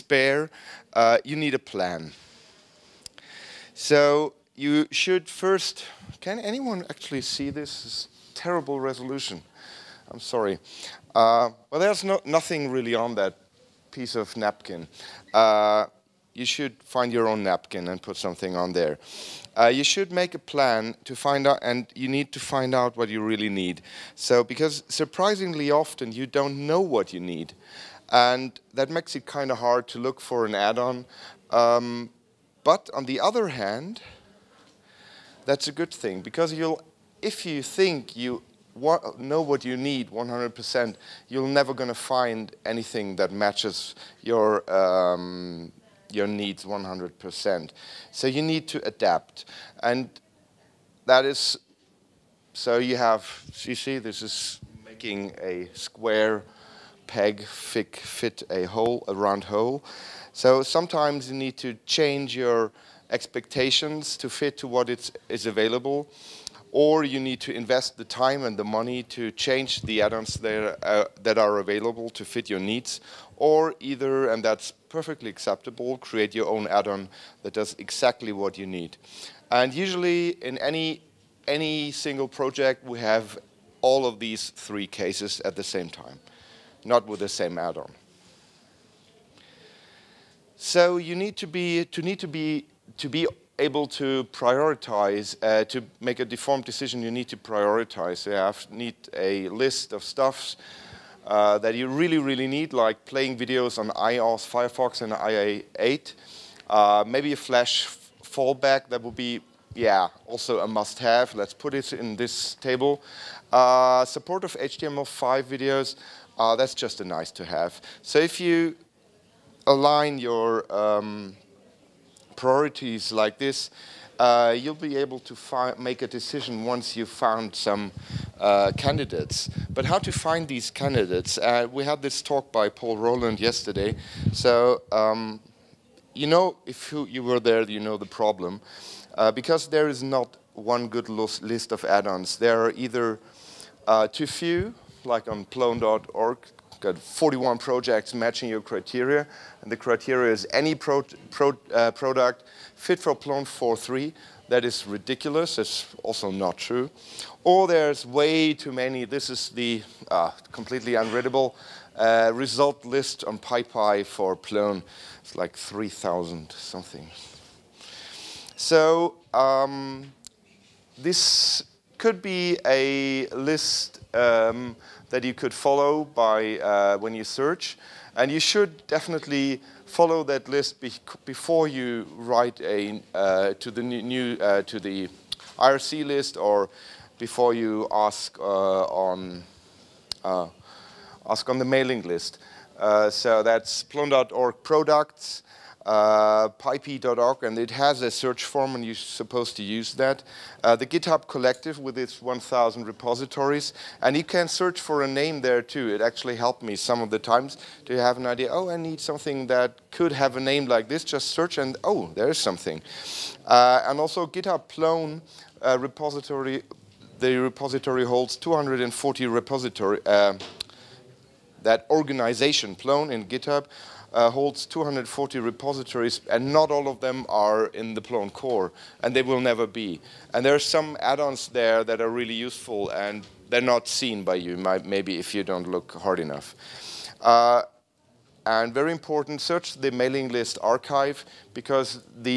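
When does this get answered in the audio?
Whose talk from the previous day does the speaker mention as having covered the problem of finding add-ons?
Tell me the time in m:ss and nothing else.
2:12.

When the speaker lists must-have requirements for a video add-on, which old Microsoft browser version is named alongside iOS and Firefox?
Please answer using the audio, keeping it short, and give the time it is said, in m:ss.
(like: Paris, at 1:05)
IE8, at 1:45.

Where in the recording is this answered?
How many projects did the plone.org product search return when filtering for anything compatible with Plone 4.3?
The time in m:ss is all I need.
2:26.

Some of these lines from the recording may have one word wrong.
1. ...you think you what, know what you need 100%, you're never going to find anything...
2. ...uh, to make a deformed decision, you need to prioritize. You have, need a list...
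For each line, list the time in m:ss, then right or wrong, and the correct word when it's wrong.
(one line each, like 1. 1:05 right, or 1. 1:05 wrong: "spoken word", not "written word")
1. 0:37 right
2. 1:35 right.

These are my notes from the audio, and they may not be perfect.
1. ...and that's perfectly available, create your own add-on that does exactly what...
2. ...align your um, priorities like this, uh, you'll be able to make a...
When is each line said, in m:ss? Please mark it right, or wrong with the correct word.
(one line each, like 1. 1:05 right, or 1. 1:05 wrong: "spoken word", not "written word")
1. 1:14 wrong: "acceptable", not "available"
2. 1:59 right.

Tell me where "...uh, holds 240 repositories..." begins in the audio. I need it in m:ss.
3:44.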